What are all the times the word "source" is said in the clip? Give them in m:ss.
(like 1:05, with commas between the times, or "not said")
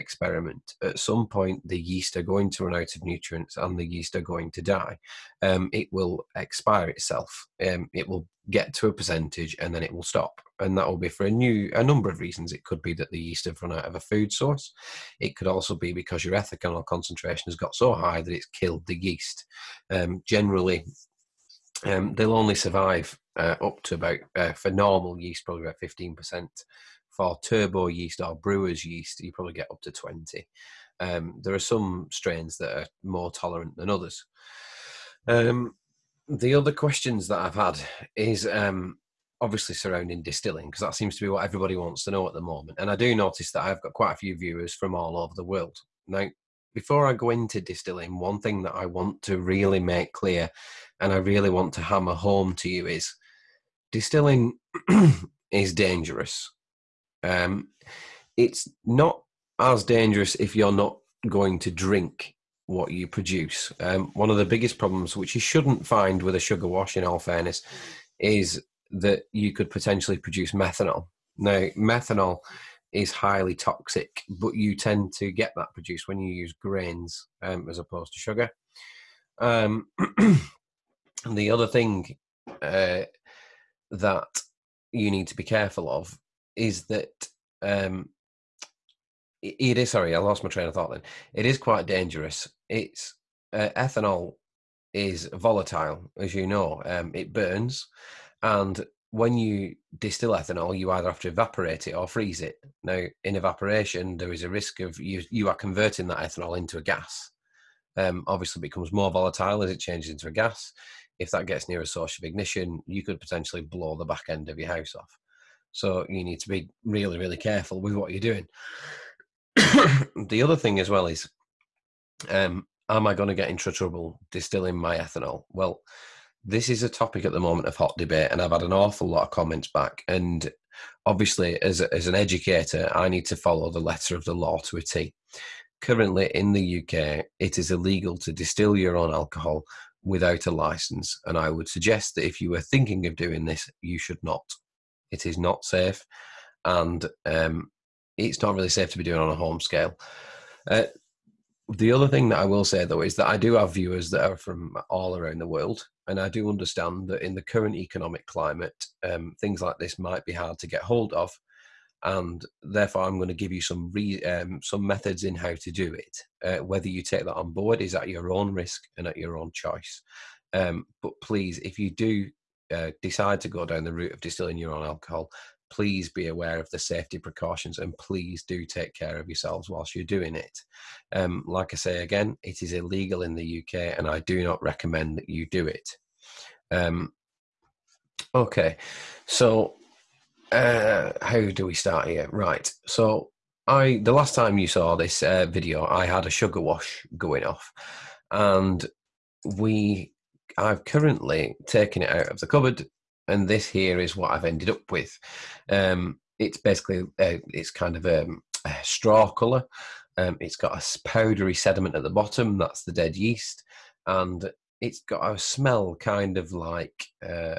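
0:14, 1:51.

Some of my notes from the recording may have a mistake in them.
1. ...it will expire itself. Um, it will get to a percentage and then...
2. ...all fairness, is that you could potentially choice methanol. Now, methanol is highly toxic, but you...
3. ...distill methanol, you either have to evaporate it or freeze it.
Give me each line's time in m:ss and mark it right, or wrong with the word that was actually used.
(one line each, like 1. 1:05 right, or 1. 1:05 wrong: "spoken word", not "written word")
1. 0:05 right
2. 1:07 wrong: "produce", not "choice"
3. 1:39 wrong: "ethanol", not "methanol".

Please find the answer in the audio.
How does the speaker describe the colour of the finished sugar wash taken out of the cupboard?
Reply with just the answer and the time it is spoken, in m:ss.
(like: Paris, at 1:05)
straw colour, at 3:28.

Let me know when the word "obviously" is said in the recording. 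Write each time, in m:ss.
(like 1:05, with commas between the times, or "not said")
0:39, 1:48, 2:11.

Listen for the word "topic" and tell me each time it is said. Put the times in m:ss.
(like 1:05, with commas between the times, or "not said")
2:06.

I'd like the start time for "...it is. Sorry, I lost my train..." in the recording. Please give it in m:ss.
1:29.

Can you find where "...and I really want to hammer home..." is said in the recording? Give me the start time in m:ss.
0:50.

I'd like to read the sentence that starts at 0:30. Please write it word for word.
Um, there are some strains that are more tolerant than others.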